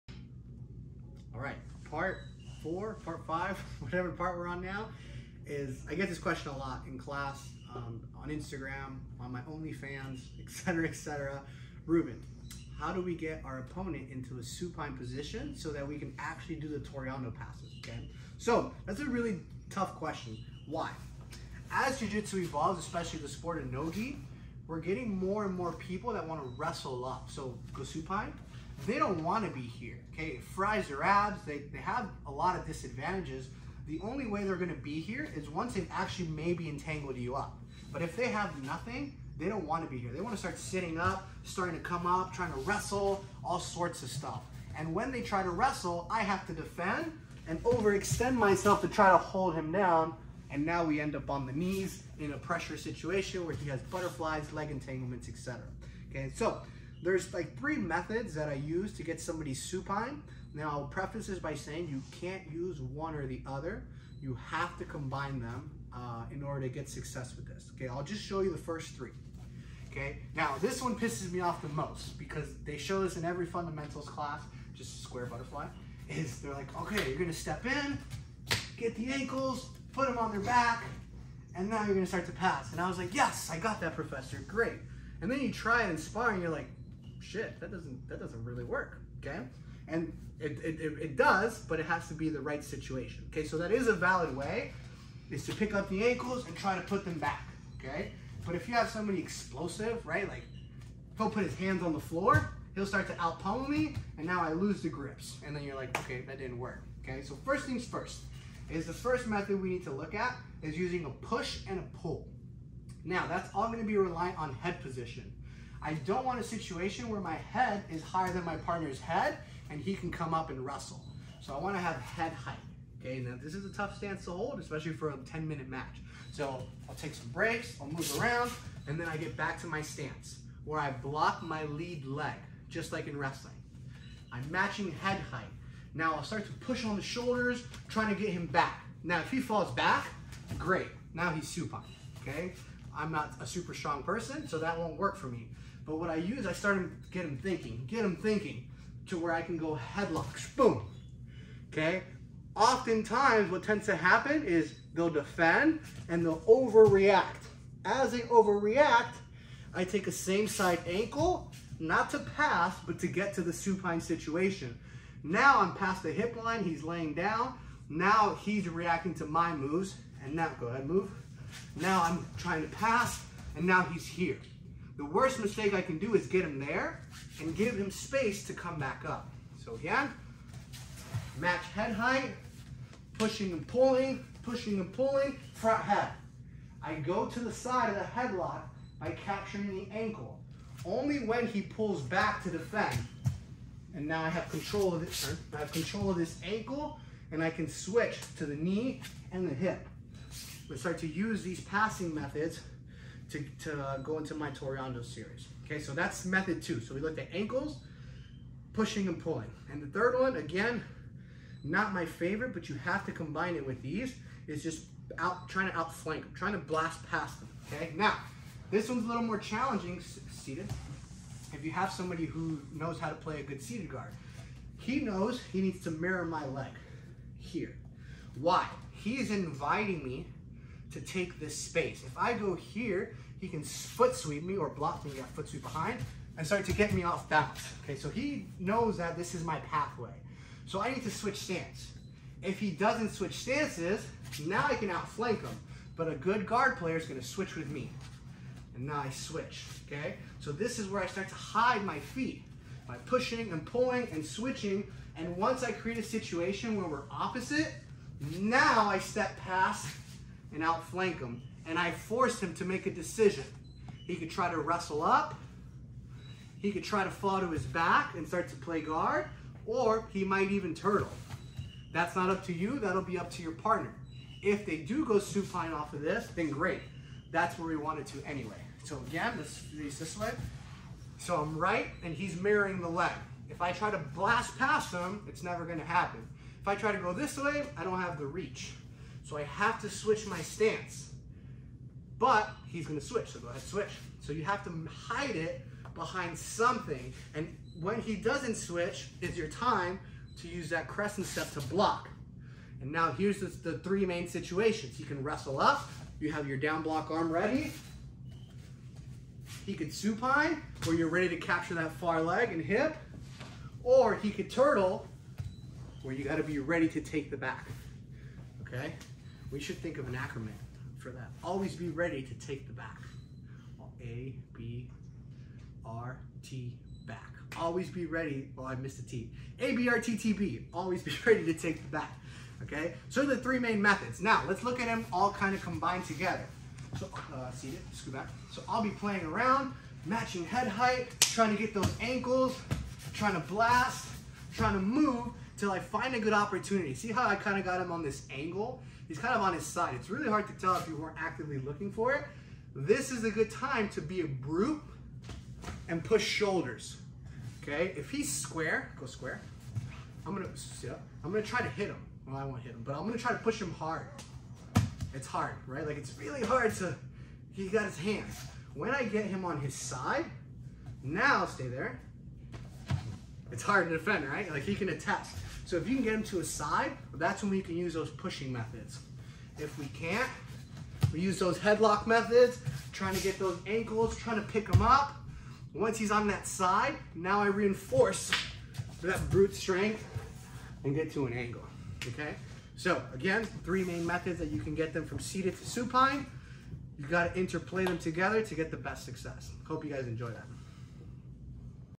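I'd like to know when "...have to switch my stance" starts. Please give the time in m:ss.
4:49.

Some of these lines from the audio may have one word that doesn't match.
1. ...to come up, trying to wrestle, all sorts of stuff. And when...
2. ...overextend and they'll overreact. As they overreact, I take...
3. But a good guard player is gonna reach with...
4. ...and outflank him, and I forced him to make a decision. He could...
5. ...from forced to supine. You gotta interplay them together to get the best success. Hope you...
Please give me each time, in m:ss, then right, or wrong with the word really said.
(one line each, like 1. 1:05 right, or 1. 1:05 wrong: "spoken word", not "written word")
1. 0:41 right
2. 2:35 wrong: "defend", not "overextend"
3. 4:05 wrong: "switch", not "reach"
4. 4:20 right
5. 6:35 wrong: "seated", not "forced".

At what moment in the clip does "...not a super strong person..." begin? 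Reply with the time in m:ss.
2:23.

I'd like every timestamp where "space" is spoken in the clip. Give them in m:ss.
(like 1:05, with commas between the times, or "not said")
2:57, 3:51.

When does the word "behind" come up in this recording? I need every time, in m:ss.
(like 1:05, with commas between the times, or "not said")
3:55, 4:55.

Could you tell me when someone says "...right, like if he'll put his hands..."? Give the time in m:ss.
1:40.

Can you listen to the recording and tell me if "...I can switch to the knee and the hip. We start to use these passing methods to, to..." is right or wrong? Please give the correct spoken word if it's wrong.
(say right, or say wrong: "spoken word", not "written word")
right.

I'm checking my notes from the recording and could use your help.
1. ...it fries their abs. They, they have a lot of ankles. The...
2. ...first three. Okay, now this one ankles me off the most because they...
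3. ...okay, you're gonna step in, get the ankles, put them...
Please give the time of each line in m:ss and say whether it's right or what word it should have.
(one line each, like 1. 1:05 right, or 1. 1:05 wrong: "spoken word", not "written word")
1. 0:30 wrong: "disadvantages", not "ankles"
2. 1:08 wrong: "pisses", not "ankles"
3. 1:16 right.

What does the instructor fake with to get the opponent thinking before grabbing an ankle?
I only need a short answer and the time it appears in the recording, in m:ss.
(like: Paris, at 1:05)
headlocks, at 2:29.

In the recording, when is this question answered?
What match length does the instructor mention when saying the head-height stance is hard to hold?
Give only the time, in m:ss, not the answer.
2:05.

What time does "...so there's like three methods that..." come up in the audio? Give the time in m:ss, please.
0:56.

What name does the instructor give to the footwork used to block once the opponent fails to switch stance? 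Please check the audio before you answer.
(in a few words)
crescent step.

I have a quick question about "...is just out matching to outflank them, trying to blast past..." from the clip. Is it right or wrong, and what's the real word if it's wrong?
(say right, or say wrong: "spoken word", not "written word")
wrong: "trying", not "matching".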